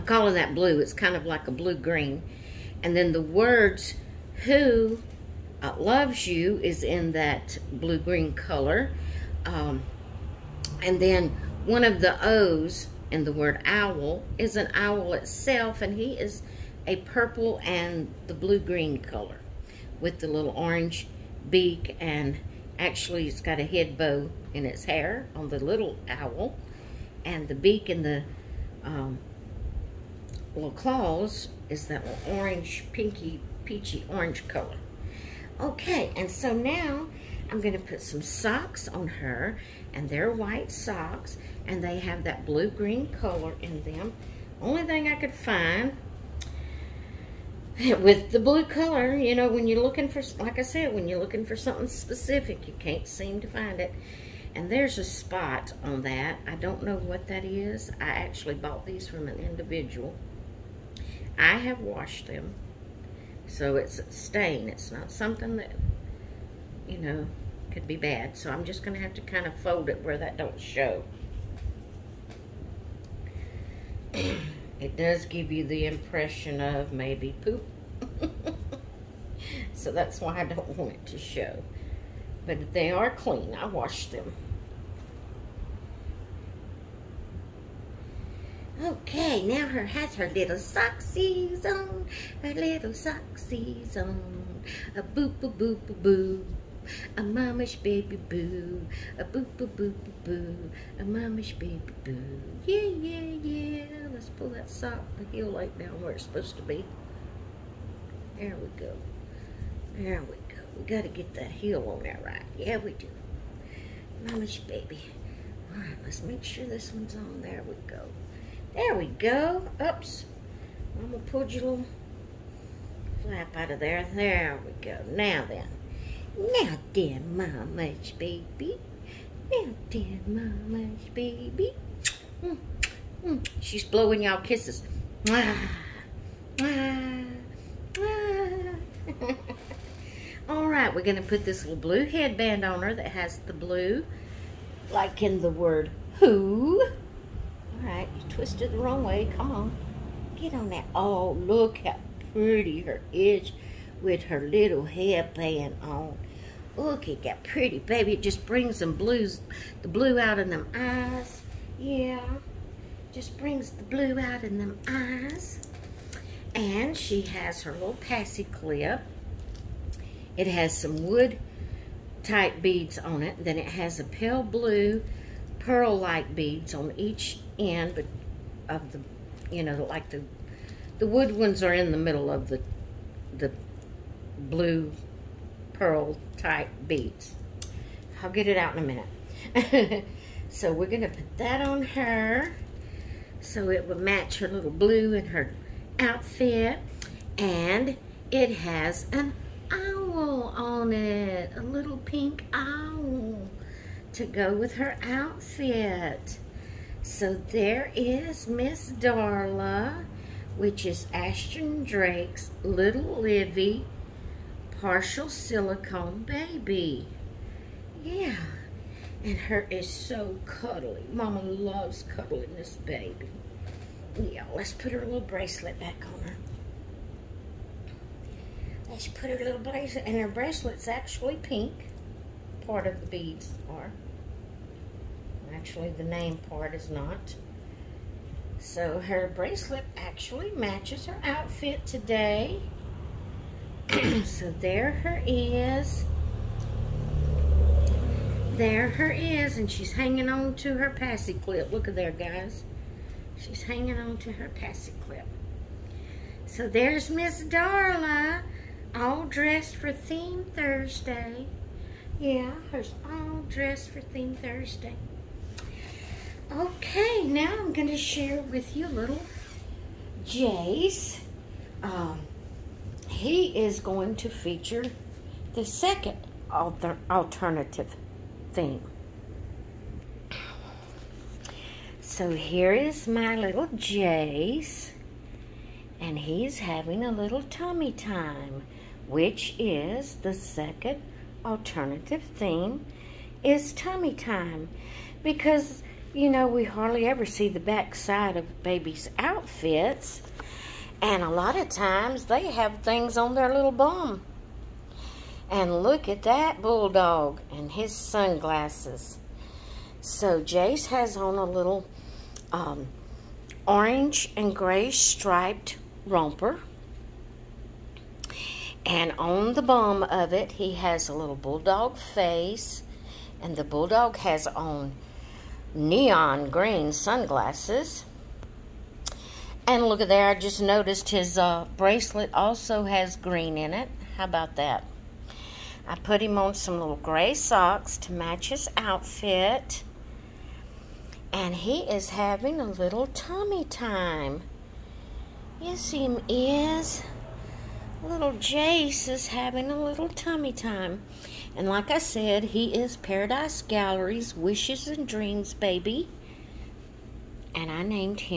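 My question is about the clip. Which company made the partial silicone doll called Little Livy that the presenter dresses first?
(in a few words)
Ashton Drake.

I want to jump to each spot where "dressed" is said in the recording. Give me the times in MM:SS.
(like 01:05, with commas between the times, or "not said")
04:19, 04:23.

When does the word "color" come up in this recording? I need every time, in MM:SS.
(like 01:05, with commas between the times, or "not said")
00:08, 00:18, 00:34, 00:43, 00:48.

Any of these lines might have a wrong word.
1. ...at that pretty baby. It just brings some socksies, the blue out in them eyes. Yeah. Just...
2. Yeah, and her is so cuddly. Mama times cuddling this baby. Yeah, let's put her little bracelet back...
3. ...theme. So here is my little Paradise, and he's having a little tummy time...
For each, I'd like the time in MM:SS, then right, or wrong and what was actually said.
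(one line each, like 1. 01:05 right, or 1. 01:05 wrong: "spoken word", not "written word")
1. 02:37 wrong: "blues", not "socksies"
2. 03:38 wrong: "loves", not "times"
3. 04:38 wrong: "Jace", not "Paradise".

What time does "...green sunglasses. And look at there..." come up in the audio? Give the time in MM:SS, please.
05:26.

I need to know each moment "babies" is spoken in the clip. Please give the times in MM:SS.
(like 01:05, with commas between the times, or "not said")
04:58.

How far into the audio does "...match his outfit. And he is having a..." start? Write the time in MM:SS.
05:38.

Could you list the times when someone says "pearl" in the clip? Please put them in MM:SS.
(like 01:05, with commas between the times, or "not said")
02:55, 03:05.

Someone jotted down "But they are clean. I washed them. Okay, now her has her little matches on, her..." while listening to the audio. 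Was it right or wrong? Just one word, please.
wrong.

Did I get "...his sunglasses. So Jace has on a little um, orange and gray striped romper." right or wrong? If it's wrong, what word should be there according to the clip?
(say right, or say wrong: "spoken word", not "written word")
right.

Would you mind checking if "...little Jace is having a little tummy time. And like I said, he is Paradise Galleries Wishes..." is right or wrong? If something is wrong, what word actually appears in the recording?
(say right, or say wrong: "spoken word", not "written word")
right.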